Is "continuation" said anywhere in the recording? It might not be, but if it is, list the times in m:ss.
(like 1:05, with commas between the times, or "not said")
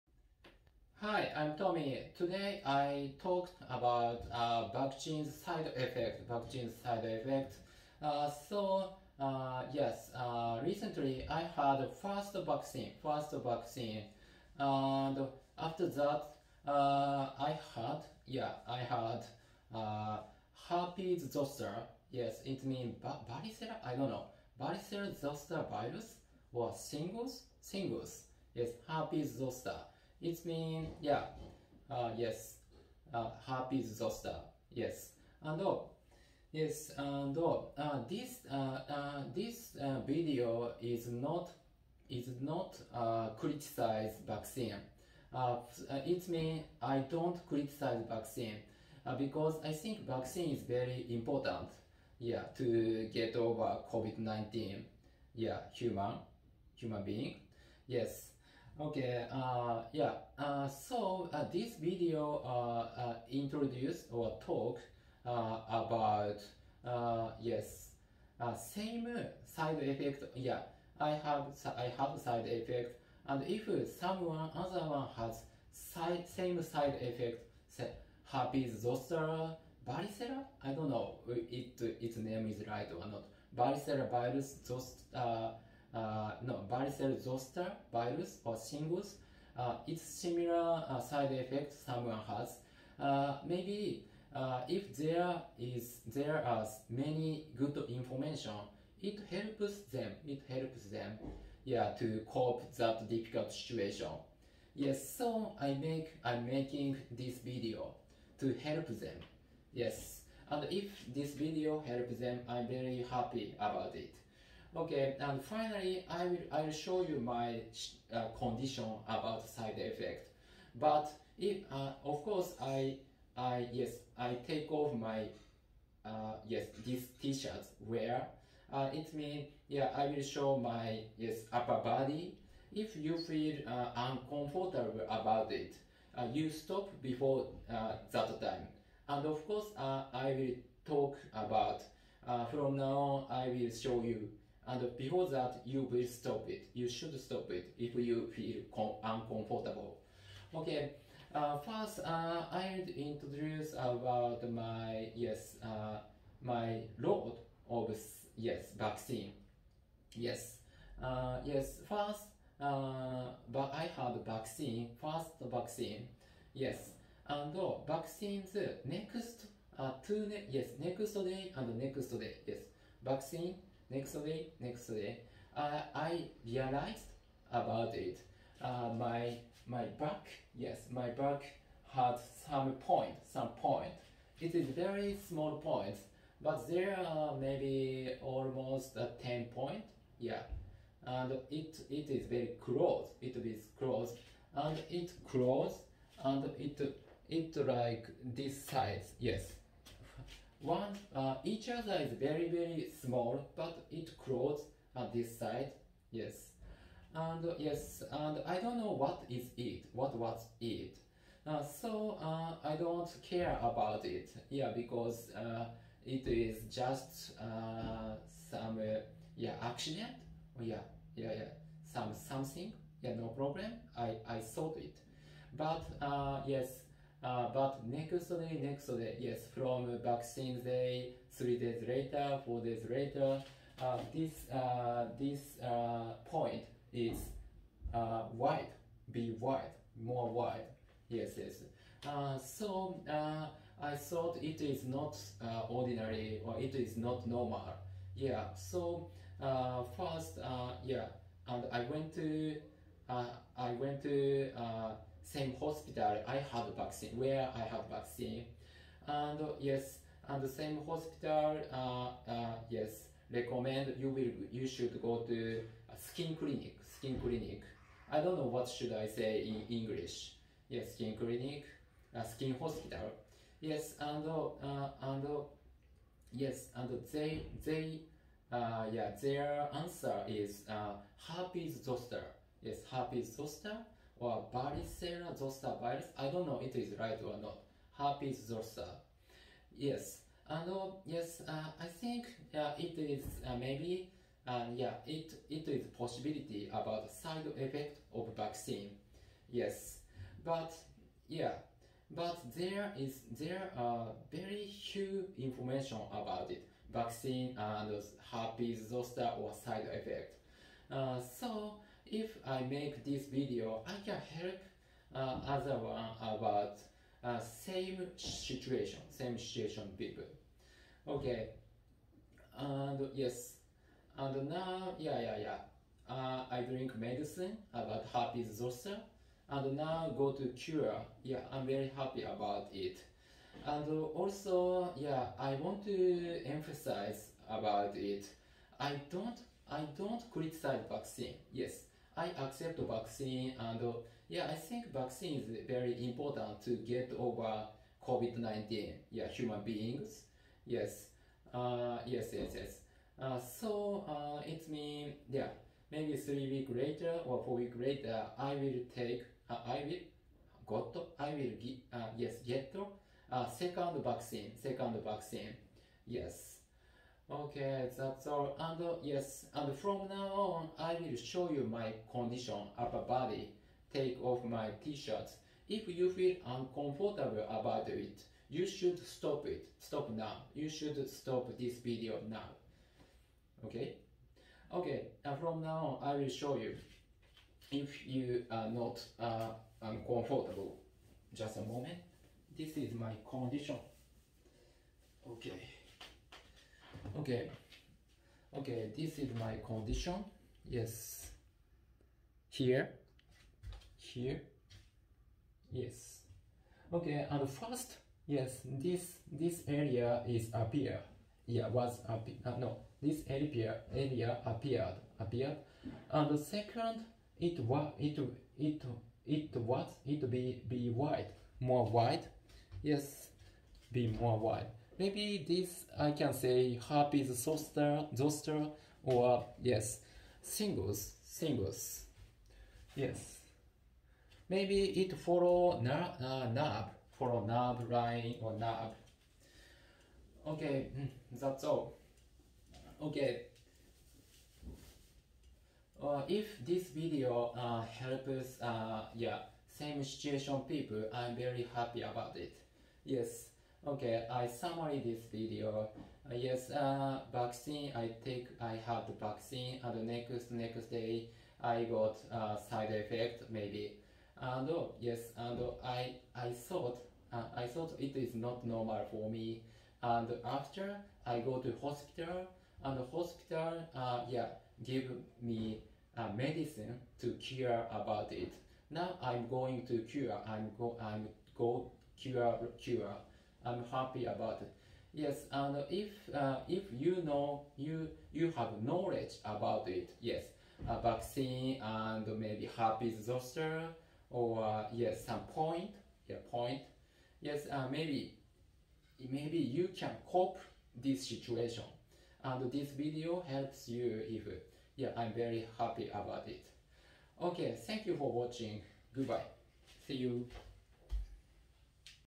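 not said.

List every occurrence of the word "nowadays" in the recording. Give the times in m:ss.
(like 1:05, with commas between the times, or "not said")
not said.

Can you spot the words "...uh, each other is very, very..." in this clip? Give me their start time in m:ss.
3:21.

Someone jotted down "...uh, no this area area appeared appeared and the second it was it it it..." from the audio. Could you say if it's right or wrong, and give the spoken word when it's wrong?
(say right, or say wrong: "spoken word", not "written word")
right.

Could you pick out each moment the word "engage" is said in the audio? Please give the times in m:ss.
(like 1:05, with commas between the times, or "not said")
not said.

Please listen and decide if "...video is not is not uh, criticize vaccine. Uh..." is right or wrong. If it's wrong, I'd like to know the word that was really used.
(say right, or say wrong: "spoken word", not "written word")
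right.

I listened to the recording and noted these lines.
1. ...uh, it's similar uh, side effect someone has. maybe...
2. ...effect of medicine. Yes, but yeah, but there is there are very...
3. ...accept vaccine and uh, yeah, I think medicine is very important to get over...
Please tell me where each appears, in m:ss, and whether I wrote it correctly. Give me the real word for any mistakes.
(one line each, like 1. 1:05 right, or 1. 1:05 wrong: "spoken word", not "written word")
1. 1:29 right
2. 4:57 wrong: "vaccine", not "medicine"
3. 5:42 wrong: "vaccine", not "medicine".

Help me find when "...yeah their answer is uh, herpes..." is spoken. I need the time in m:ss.
4:38.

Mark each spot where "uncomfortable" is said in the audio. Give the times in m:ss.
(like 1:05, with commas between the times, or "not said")
2:13, 2:29, 6:16, 6:29.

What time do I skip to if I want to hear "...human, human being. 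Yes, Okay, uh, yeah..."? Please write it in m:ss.
0:55.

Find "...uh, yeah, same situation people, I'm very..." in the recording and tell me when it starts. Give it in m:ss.
7:28.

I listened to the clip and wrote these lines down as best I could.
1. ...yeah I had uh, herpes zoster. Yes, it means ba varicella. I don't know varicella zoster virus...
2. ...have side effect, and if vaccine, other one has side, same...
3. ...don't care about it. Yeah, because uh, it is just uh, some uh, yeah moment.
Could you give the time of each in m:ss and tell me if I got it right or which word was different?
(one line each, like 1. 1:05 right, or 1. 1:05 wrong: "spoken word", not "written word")
1. 0:18 right
2. 1:11 wrong: "someone", not "vaccine"
3. 3:32 wrong: "accident", not "moment".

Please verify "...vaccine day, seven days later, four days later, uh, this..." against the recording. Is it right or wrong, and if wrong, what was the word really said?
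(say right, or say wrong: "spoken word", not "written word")
wrong: "three", not "seven".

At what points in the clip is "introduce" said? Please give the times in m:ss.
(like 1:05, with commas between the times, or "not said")
1:03, 2:32.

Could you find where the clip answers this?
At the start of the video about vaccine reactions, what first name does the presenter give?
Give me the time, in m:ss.
0:01.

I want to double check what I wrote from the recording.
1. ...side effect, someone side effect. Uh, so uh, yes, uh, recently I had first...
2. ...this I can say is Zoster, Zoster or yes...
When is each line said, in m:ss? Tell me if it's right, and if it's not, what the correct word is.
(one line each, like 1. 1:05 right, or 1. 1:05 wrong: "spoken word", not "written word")
1. 0:05 wrong: "vaccine", not "someone"
2. 7:05 right.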